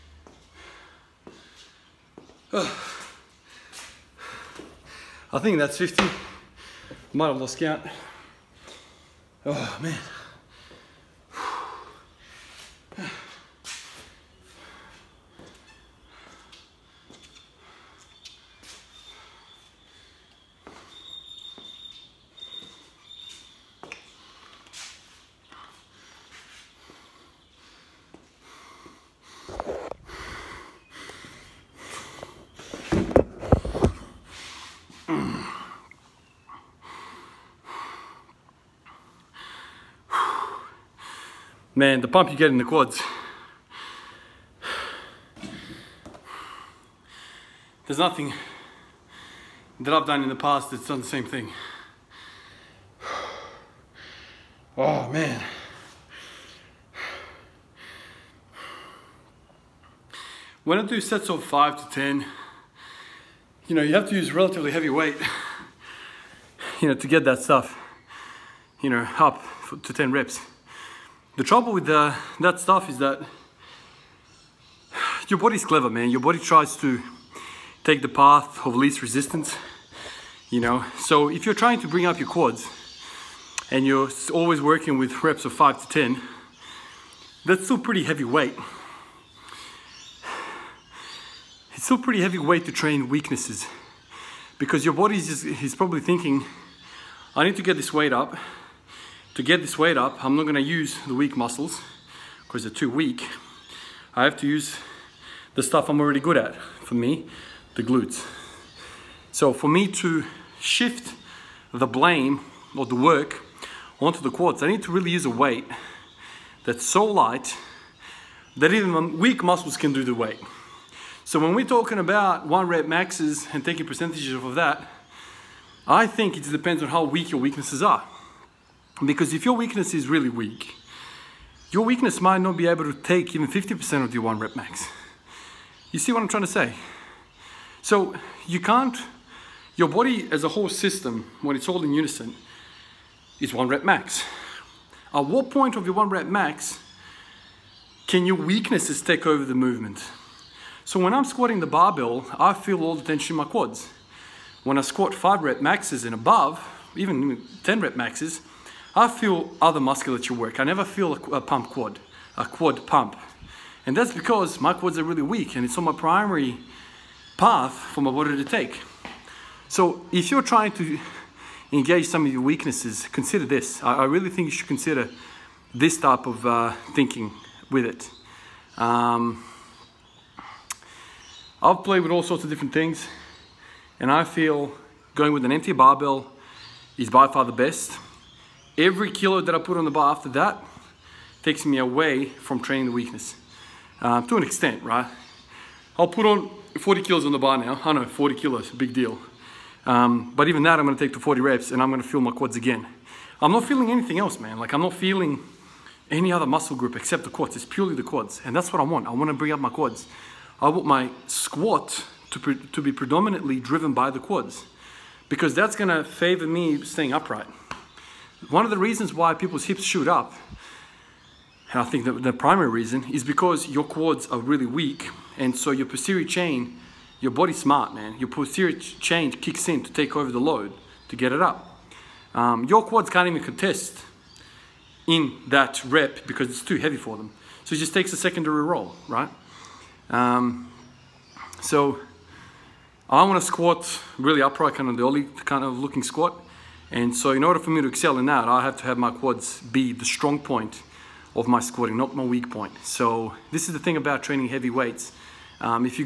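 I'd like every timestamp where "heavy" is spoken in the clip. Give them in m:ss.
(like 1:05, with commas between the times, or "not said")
1:04, 1:28, 1:32, 3:56, 4:14.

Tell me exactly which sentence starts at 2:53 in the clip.
I, I really think you should consider this type of uh, thinking with it.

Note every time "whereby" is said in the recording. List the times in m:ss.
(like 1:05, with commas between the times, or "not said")
not said.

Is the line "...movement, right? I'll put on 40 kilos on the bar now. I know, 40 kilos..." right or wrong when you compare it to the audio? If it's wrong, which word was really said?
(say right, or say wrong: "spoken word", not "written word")
wrong: "extent", not "movement".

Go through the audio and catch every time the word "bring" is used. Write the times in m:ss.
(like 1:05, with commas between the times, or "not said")
1:21, 3:29.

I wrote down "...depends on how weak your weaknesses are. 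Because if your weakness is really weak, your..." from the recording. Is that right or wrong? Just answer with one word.
right.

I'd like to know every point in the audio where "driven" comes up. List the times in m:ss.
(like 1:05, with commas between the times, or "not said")
3:33.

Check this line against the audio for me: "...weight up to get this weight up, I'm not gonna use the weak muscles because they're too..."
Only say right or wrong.
right.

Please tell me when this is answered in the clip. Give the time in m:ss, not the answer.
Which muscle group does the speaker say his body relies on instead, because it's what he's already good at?
1:47.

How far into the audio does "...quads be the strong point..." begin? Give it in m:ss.
4:09.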